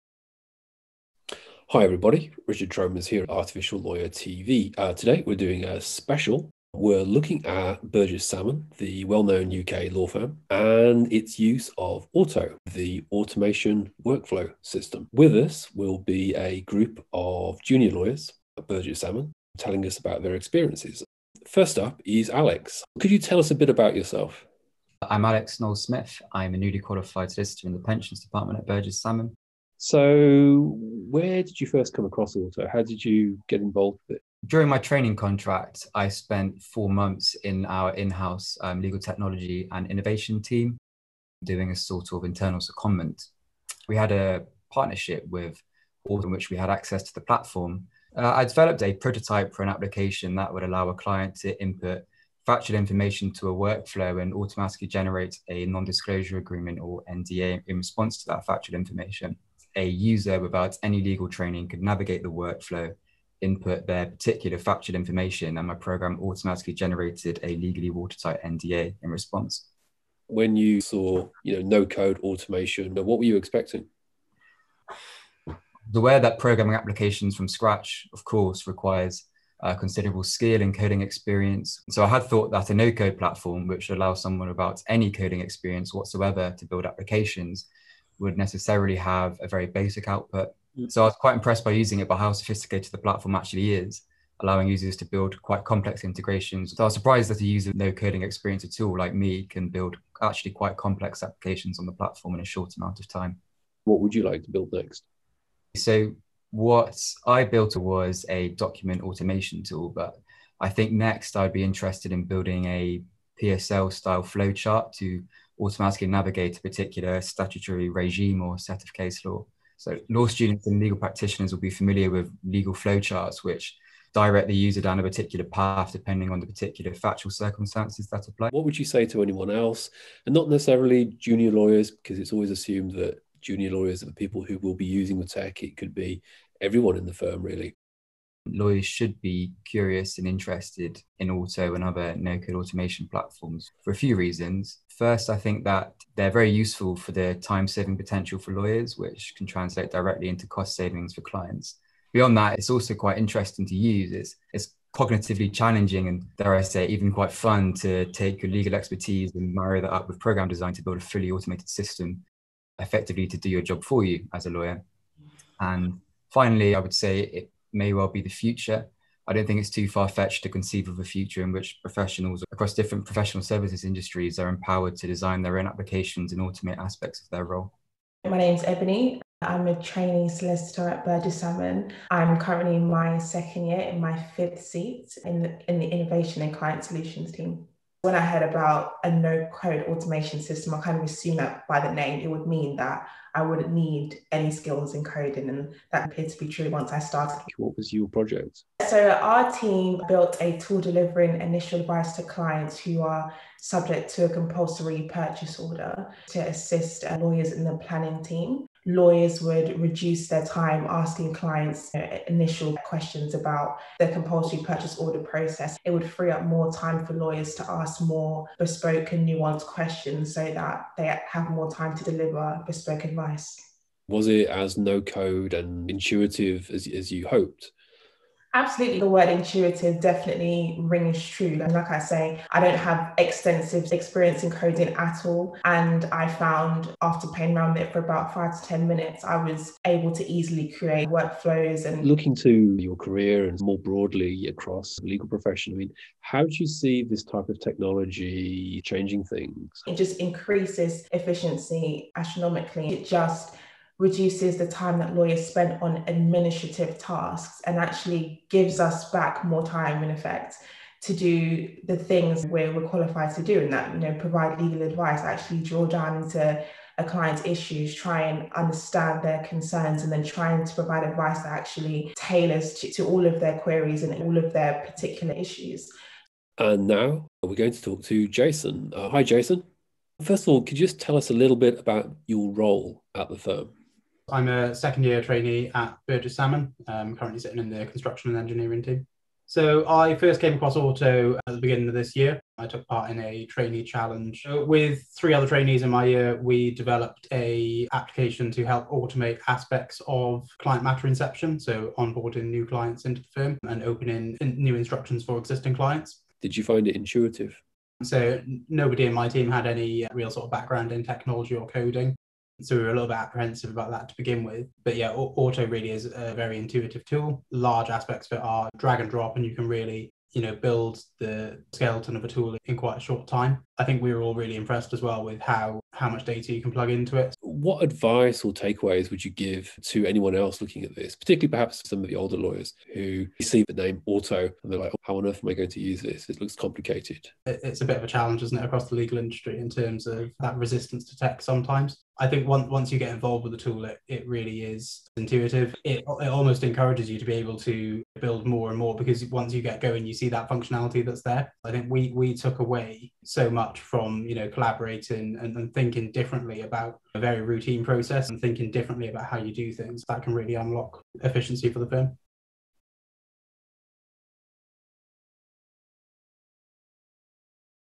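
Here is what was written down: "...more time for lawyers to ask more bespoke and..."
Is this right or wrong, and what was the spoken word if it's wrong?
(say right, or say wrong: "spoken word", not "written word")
right.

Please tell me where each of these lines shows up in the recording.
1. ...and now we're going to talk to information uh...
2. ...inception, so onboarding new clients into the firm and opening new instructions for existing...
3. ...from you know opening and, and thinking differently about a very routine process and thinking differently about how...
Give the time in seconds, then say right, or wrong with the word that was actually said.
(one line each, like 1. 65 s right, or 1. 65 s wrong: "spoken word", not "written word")
1. 276 s wrong: "jason", not "information"
2. 301 s right
3. 353 s wrong: "collaborating", not "opening".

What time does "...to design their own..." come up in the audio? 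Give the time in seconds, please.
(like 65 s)
174 s.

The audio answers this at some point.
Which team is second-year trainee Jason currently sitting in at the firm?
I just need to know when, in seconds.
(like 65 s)
287 s.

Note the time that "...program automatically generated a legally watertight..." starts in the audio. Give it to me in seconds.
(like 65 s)
65 s.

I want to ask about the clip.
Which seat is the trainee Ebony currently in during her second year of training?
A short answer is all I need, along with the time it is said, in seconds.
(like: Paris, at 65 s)
Fifth, at 184 s.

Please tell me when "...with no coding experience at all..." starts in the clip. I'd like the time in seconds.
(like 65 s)
97 s.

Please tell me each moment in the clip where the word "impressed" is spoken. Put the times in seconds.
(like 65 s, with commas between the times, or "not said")
91 s, 324 s.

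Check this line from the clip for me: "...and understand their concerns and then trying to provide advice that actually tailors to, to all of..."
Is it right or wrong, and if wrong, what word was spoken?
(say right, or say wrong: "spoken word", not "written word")
right.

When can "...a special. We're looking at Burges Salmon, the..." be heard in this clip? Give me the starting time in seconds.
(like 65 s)
5 s.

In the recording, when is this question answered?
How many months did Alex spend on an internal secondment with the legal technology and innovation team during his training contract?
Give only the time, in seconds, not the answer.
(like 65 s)
36 s.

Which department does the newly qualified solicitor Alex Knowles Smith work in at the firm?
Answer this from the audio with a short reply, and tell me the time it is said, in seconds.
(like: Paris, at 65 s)
Pensions, at 27 s.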